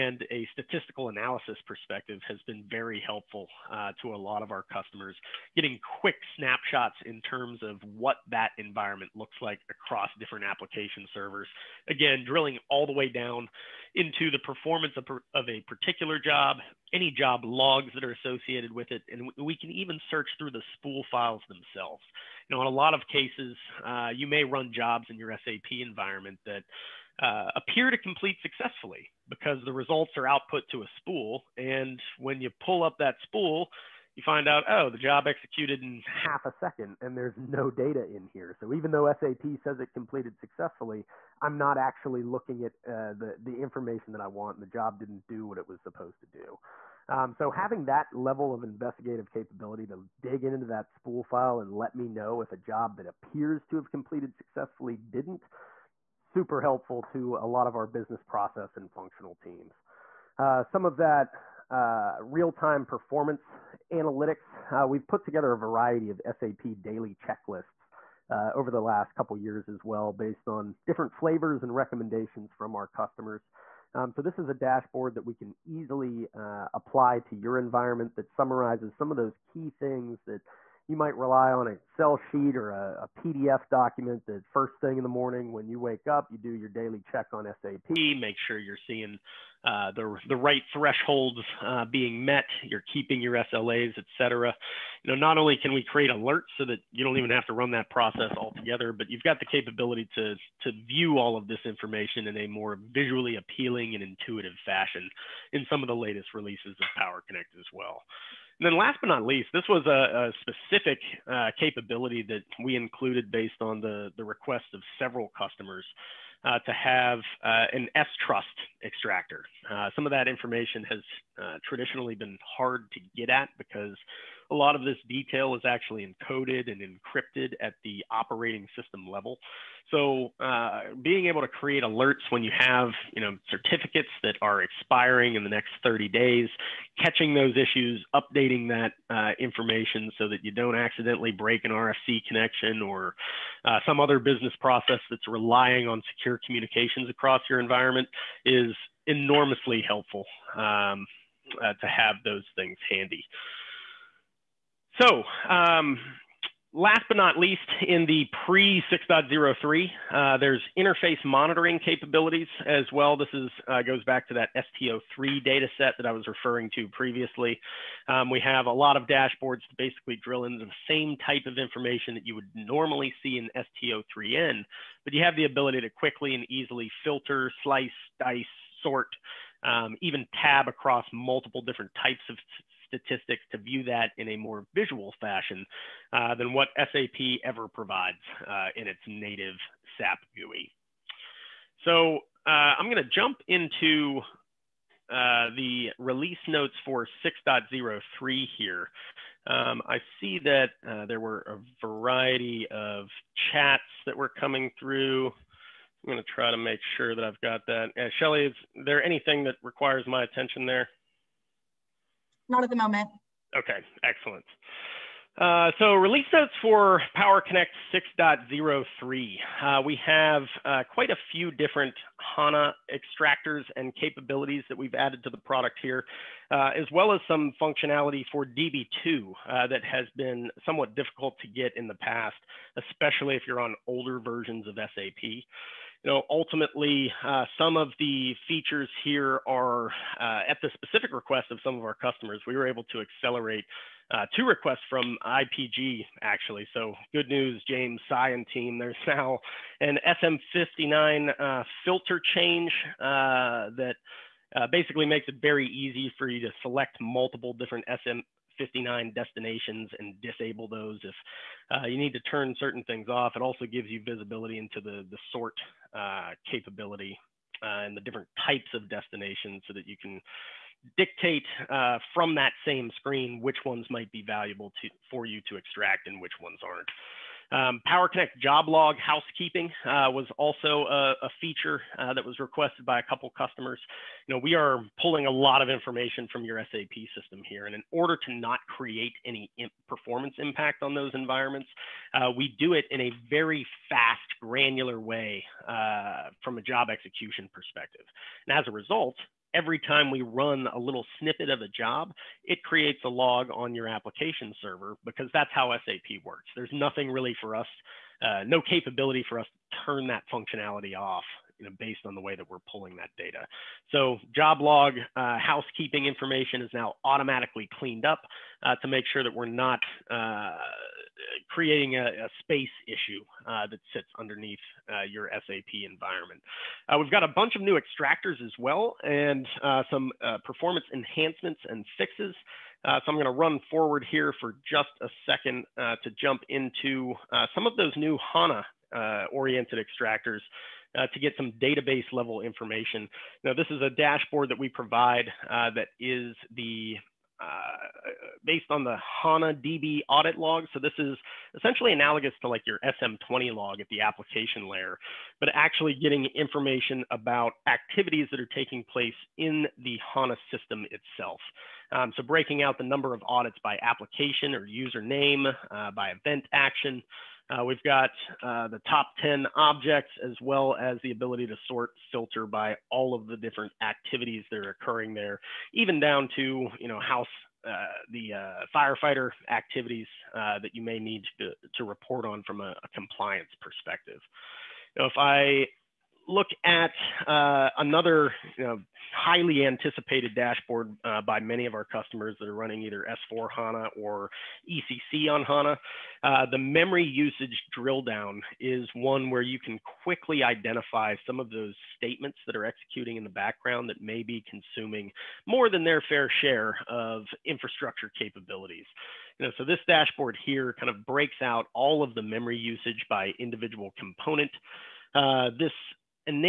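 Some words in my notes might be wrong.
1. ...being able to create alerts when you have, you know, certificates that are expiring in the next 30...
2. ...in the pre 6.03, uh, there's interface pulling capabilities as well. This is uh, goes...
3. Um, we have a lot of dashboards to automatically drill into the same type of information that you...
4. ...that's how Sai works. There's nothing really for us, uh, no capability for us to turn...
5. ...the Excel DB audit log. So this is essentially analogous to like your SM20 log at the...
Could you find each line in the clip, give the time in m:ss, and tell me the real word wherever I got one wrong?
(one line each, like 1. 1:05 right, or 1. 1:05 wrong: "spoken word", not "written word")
1. 2:11 right
2. 2:37 wrong: "monitoring", not "pulling"
3. 2:48 wrong: "basically", not "automatically"
4. 5:05 wrong: "SAP", not "Sai"
5. 5:48 wrong: "HANA", not "Excel".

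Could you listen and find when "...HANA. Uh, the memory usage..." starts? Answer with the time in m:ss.
6:35.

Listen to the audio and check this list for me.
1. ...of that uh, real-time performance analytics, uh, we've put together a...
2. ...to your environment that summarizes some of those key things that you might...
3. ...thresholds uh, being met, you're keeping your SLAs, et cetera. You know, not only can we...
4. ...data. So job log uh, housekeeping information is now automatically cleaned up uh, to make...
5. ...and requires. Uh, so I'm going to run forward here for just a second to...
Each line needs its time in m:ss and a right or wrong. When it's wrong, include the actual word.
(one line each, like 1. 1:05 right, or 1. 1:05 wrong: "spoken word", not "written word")
1. 1:00 right
2. 1:17 right
3. 1:30 right
4. 5:13 right
5. 5:31 wrong: "fixes", not "requires".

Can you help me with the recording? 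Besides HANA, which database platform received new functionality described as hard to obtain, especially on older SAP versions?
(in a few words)
DB2.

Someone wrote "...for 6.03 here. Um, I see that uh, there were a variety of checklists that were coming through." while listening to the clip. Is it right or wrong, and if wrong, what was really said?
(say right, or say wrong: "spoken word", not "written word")
wrong: "chats", not "checklists".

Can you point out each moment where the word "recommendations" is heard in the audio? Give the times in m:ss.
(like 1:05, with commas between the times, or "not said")
1:11.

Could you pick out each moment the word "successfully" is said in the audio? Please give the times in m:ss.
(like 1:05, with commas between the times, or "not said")
0:28, 0:40, 0:54.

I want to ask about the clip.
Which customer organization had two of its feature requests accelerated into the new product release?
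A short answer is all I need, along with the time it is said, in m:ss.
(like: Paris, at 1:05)
IPG, at 4:05.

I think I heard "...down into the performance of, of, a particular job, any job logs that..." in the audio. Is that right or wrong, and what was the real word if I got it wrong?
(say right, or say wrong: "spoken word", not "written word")
right.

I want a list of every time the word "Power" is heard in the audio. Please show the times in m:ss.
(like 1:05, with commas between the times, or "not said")
1:46, 3:37, 4:37.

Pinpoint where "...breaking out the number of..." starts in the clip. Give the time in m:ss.
6:02.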